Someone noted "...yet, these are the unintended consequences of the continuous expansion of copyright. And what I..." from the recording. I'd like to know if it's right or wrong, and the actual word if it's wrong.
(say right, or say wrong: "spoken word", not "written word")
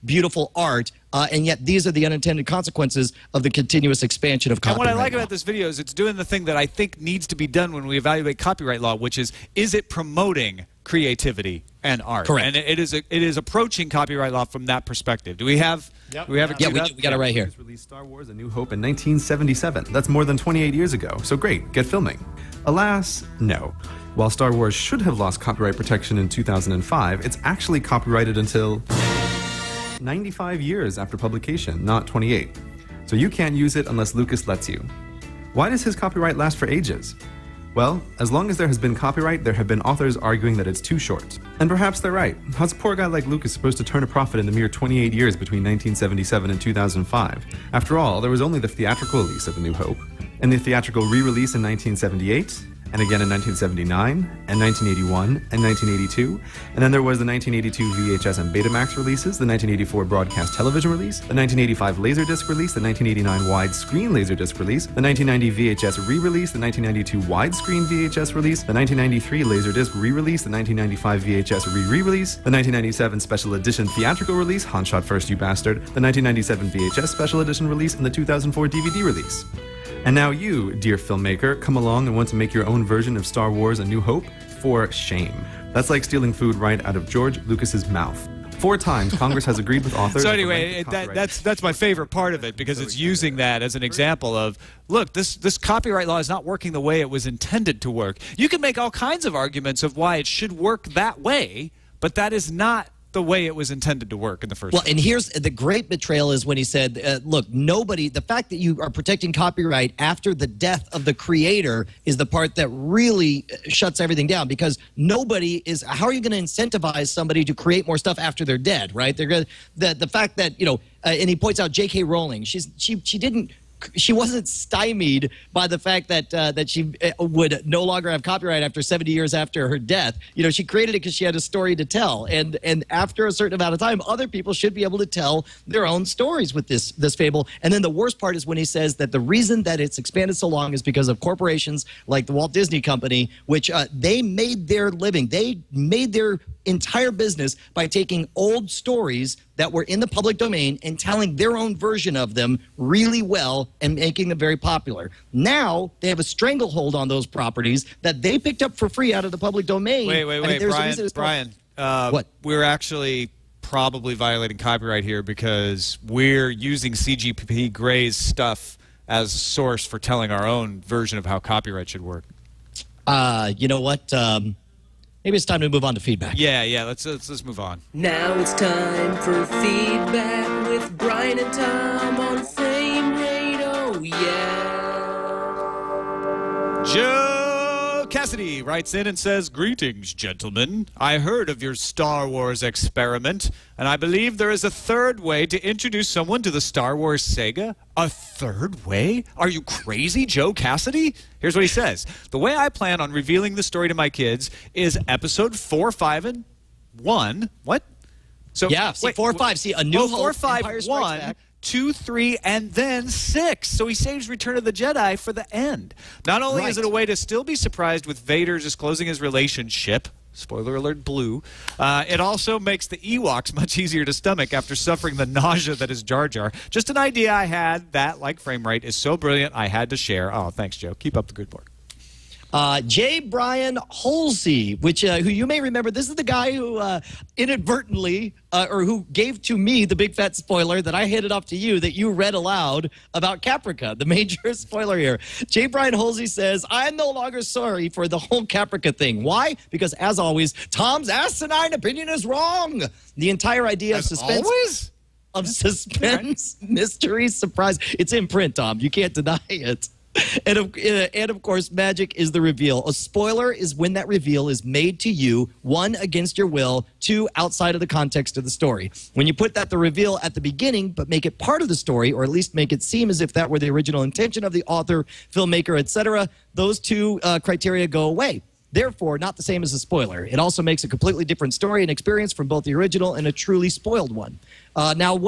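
right.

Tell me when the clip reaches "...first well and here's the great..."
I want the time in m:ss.
1:44.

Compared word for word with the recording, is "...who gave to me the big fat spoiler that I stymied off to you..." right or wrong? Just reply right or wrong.
wrong.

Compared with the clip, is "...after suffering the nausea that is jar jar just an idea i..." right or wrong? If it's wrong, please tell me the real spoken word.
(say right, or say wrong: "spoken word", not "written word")
right.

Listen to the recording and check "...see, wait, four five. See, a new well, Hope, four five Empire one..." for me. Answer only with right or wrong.
right.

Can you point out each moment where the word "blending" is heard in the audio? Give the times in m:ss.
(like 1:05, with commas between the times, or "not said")
not said.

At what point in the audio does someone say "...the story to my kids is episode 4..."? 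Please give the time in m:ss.
3:23.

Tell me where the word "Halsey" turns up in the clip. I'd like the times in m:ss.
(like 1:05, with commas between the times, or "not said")
3:54, 4:05.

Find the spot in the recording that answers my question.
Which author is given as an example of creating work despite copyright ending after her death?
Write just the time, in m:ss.
2:01.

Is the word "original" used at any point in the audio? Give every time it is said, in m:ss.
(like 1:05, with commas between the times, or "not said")
4:33, 4:42.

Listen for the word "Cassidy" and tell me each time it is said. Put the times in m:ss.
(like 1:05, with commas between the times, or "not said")
3:08, 3:20.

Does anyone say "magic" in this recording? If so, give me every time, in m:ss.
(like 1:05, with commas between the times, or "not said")
4:21.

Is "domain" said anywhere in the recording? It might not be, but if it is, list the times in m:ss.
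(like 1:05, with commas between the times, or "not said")
2:30, 2:39.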